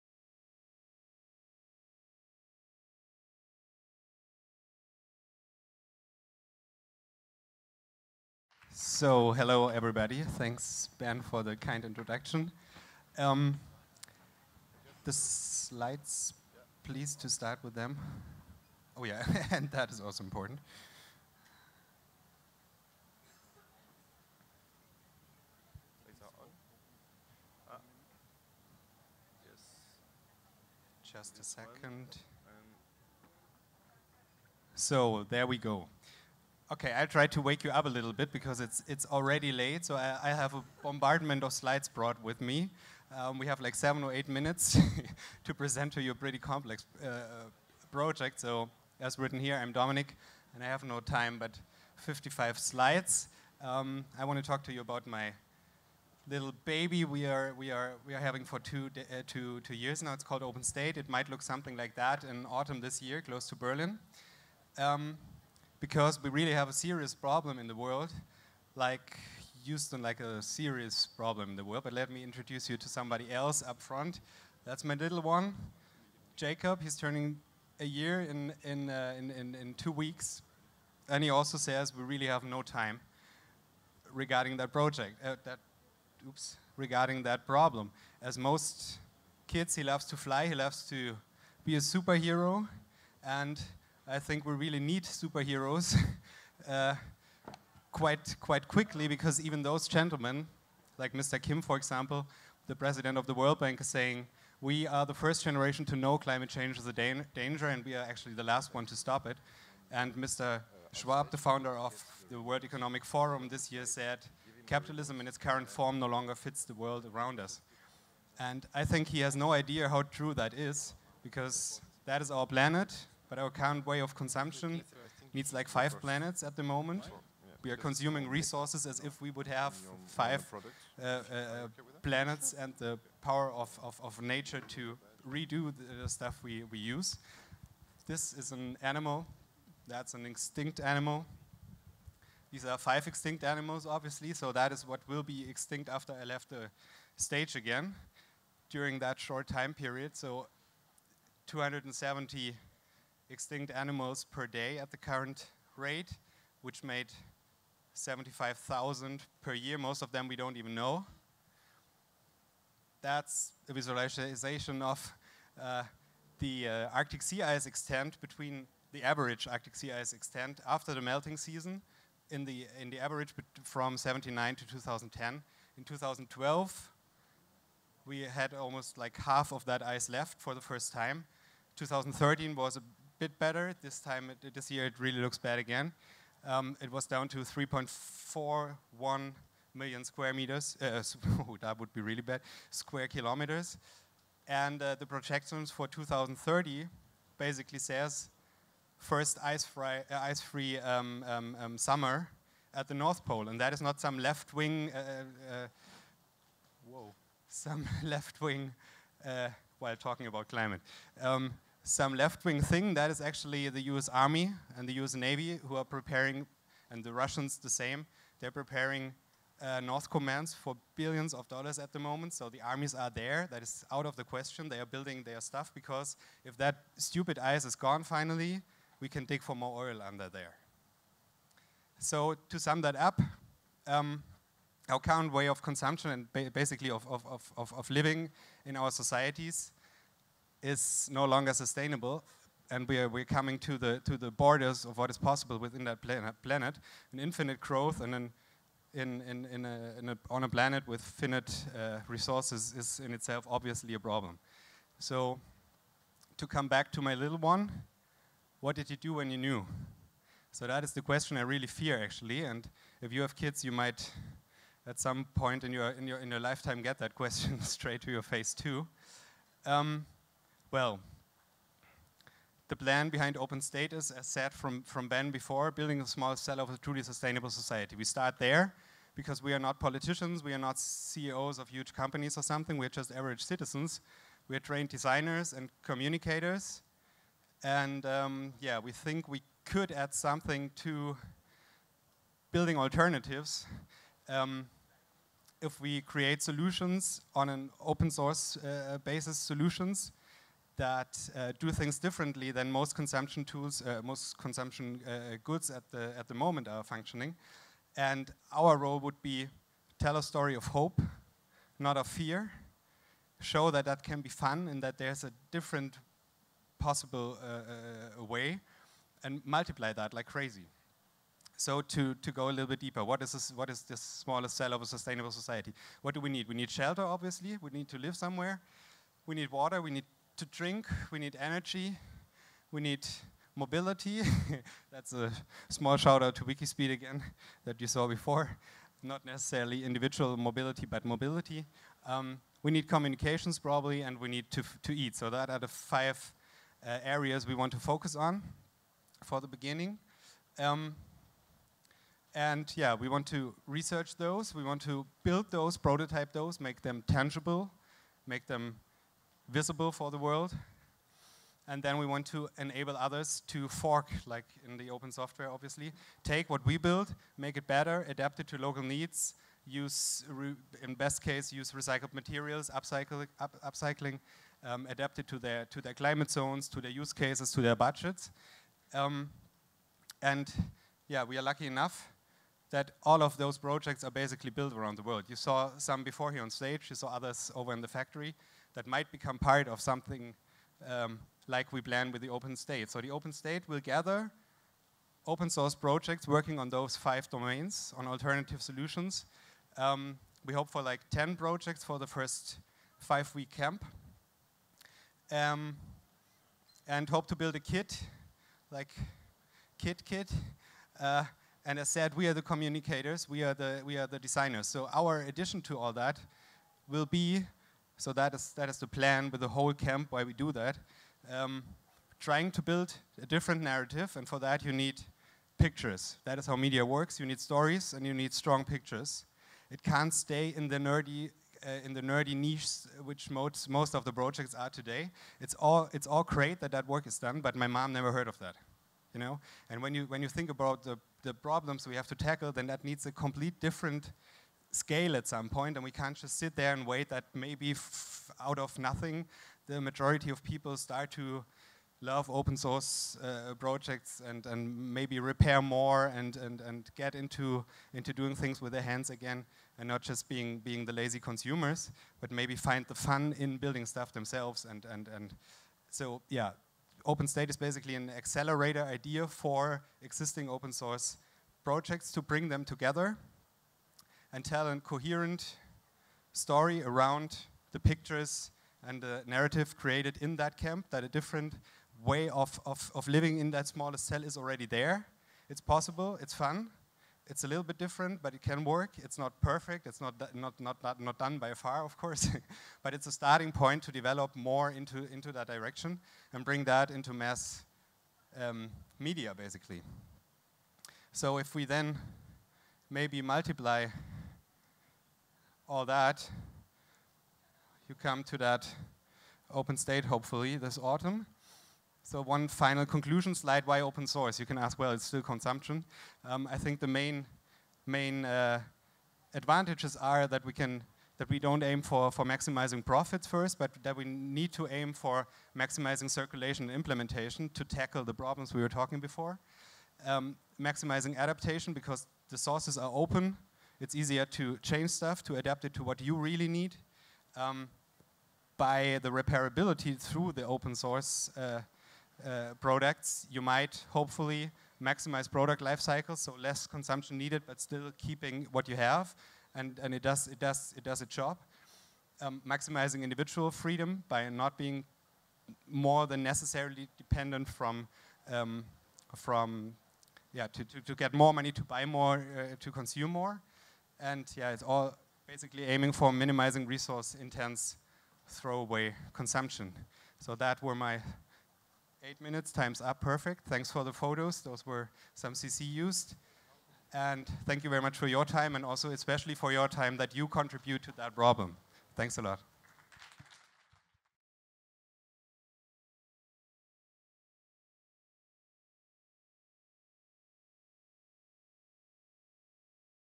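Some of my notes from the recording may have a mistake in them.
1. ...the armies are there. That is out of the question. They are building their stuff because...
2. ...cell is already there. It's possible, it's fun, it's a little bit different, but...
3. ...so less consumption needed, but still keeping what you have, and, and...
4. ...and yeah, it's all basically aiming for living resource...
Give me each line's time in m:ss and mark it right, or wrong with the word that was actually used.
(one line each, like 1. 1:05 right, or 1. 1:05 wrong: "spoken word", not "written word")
1. 3:42 right
2. 8:03 right
3. 9:06 right
4. 9:24 wrong: "minimizing", not "living".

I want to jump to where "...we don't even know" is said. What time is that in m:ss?
2:40.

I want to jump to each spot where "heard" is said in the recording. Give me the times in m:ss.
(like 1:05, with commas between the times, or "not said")
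7:18.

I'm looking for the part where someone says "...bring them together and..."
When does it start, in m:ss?
7:52.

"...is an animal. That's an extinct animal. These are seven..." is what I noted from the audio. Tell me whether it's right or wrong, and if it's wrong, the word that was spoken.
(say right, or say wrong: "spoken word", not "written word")
wrong: "five", not "seven".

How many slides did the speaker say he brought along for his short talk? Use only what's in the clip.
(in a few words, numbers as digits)
55.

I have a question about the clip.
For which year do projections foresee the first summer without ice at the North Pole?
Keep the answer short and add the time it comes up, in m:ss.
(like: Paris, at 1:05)
2030, at 3:15.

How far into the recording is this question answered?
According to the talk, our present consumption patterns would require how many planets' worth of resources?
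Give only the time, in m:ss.
2:05.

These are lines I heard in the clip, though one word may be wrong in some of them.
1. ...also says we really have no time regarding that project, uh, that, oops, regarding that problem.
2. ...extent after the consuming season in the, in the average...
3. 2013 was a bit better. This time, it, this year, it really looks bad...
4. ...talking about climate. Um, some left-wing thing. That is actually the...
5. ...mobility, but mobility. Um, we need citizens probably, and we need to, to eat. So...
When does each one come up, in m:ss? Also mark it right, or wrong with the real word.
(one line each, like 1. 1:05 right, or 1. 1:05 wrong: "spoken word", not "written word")
1. 1:21 right
2. 2:50 wrong: "melting", not "consuming"
3. 3:01 right
4. 3:29 right
5. 5:40 wrong: "communications", not "citizens".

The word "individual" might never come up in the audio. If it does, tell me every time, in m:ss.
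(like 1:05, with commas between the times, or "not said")
5:39, 9:13.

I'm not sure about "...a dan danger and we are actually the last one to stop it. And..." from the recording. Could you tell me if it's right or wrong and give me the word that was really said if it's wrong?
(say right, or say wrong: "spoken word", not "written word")
right.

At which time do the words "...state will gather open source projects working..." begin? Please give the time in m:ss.
6:33.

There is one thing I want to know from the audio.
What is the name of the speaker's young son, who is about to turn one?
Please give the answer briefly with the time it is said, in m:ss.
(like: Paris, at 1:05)
Jacob, at 1:16.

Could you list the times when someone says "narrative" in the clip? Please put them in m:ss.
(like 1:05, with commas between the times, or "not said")
7:03, 7:59.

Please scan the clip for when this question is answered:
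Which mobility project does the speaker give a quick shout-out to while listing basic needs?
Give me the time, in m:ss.
5:36.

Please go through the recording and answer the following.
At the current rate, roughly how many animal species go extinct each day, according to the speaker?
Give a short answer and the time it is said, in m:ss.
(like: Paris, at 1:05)
270, at 2:31.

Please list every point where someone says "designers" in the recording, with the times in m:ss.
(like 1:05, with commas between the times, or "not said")
4:44, 6:54.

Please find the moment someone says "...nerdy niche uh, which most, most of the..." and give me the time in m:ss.
7:12.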